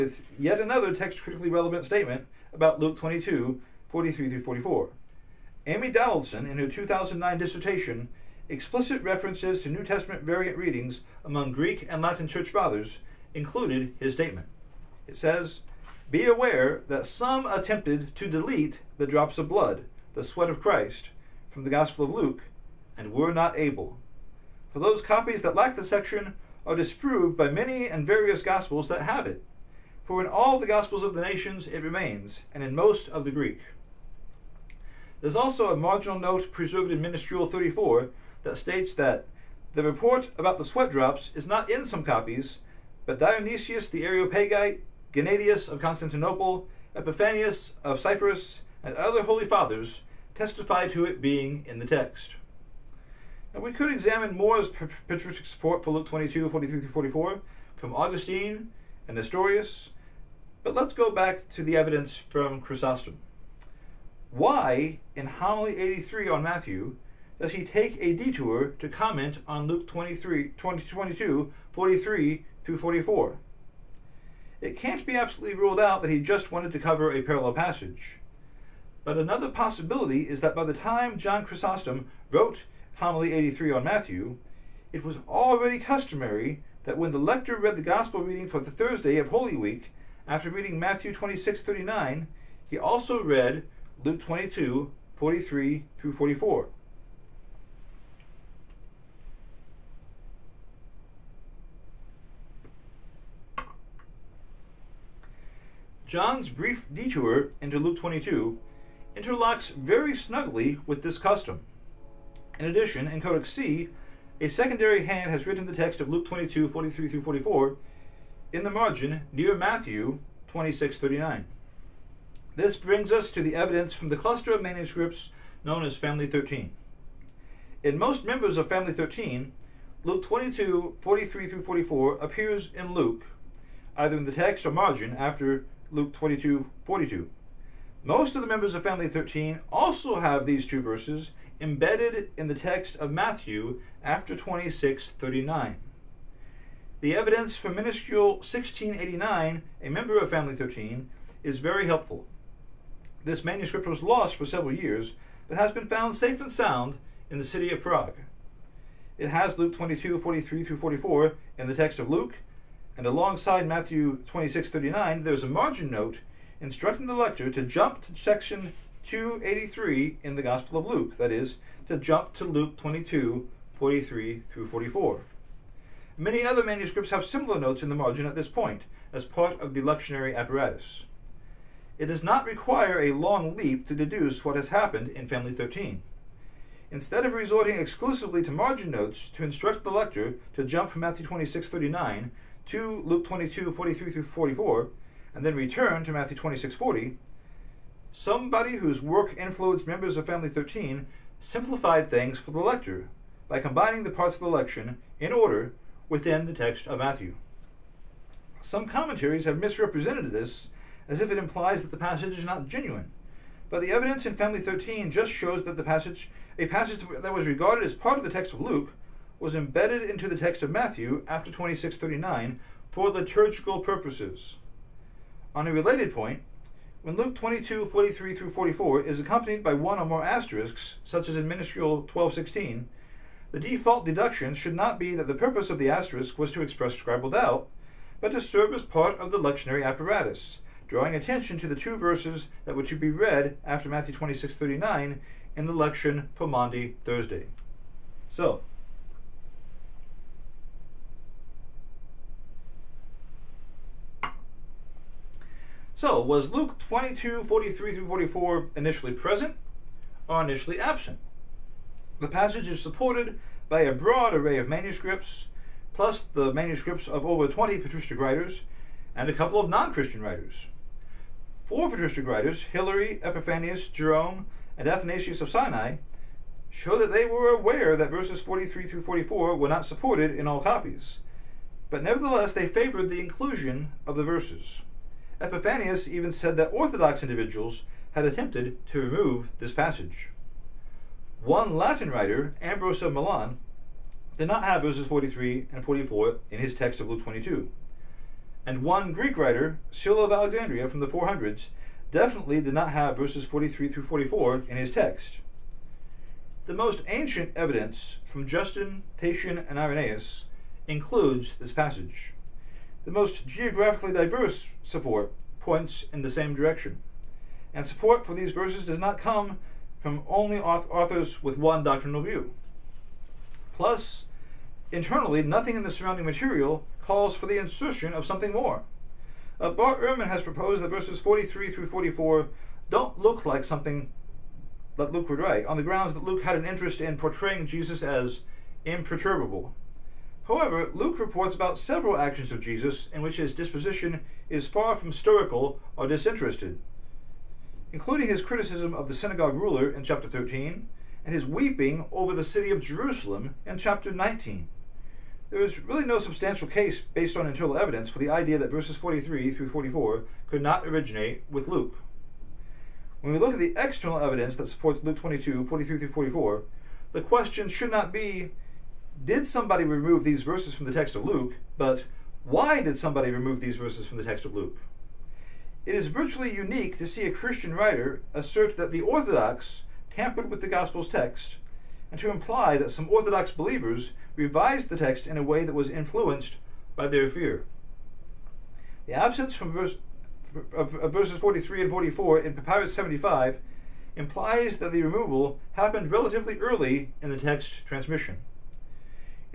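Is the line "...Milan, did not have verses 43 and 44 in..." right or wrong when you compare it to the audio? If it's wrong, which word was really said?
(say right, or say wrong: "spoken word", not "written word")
right.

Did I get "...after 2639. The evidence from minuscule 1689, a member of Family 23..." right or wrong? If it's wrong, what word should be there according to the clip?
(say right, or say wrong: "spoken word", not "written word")
wrong: "13", not "23".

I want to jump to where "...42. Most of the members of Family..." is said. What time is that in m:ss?
2:16.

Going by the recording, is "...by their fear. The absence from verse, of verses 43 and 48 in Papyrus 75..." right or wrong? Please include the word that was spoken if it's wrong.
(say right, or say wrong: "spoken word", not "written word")
wrong: "44", not "48".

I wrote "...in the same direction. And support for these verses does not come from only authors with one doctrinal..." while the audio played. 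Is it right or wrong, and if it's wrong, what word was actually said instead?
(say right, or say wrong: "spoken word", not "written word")
right.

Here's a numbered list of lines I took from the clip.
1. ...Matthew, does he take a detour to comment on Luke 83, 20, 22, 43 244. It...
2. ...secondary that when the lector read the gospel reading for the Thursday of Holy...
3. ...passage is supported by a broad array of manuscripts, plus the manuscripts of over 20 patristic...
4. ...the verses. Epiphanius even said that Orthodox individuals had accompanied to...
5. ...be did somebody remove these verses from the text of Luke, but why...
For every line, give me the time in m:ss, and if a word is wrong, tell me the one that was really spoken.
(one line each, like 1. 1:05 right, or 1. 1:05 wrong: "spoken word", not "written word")
1. 1:06 wrong: "23", not "83"
2. 1:25 wrong: "customary", not "secondary"
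3. 4:22 right
4. 4:44 wrong: "attempted", not "accompanied"
5. 6:08 right.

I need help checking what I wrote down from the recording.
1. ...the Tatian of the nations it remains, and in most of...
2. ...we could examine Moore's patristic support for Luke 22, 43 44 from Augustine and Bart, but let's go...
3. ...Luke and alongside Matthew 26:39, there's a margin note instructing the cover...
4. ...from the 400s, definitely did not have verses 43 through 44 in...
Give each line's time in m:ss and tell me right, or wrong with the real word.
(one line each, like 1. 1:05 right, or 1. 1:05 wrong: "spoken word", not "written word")
1. 0:30 wrong: "Gospels", not "Tatian"
2. 0:53 wrong: "Nestorius", not "Bart"
3. 2:42 wrong: "lecturer", not "cover"
4. 5:00 right.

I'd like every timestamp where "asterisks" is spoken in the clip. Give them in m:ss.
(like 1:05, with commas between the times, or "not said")
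3:50, 3:55.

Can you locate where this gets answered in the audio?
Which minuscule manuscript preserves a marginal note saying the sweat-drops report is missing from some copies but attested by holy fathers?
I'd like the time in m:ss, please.
0:37.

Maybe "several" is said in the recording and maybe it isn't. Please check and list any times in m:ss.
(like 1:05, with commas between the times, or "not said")
2:34, 5:41.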